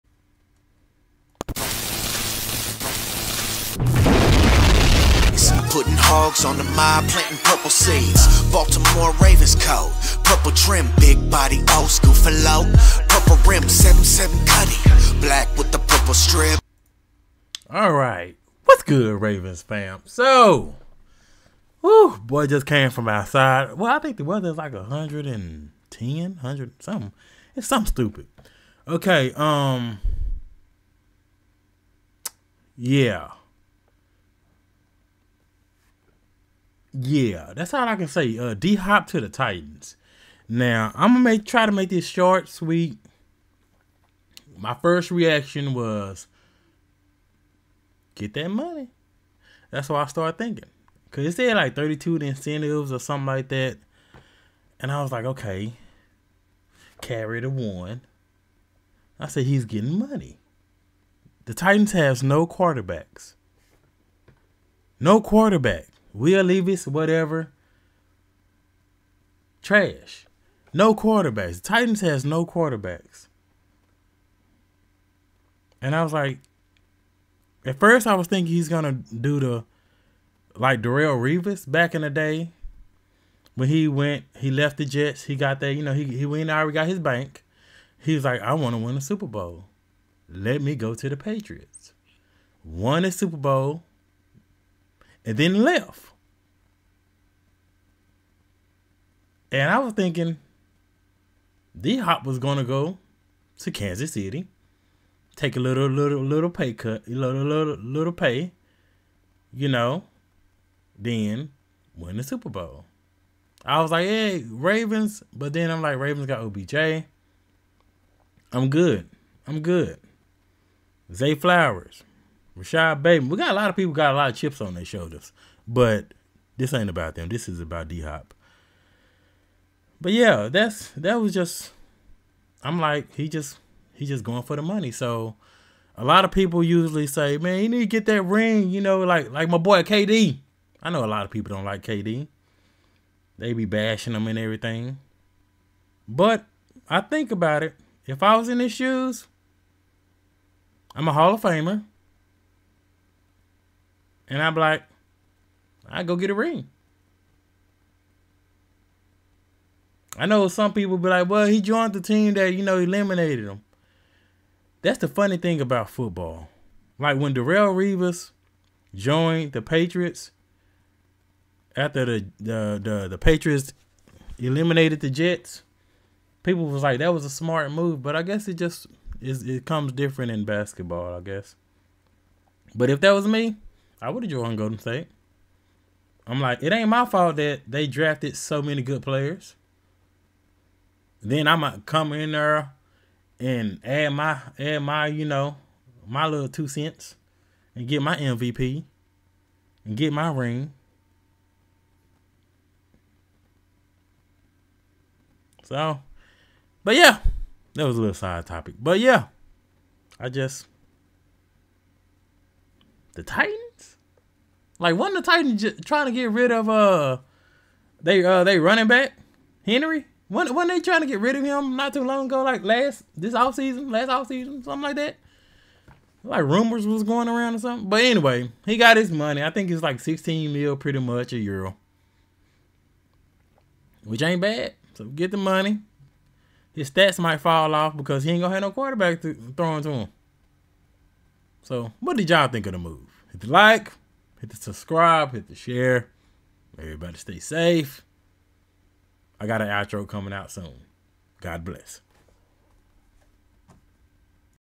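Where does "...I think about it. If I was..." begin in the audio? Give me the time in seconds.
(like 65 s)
146 s.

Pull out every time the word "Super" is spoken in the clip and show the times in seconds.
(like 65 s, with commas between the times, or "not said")
89 s, 93 s, 112 s.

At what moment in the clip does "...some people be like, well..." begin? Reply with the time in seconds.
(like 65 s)
160 s.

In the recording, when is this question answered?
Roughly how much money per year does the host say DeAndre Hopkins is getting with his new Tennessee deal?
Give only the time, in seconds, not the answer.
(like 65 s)
229 s.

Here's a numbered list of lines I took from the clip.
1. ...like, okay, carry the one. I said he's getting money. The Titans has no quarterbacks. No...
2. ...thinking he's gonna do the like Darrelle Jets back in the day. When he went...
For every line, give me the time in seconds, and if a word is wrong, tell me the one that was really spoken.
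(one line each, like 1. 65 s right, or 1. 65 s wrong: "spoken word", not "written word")
1. 55 s right
2. 78 s wrong: "Revis", not "Jets".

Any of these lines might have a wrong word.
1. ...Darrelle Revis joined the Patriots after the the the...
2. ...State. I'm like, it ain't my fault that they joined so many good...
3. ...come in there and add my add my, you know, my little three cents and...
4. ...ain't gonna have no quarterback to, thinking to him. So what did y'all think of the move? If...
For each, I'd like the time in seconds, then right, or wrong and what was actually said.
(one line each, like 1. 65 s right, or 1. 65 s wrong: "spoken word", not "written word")
1. 167 s right
2. 184 s wrong: "drafted", not "joined"
3. 191 s wrong: "two", not "three"
4. 238 s wrong: "throwing", not "thinking".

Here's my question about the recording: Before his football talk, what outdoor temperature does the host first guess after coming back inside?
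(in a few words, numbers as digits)
110.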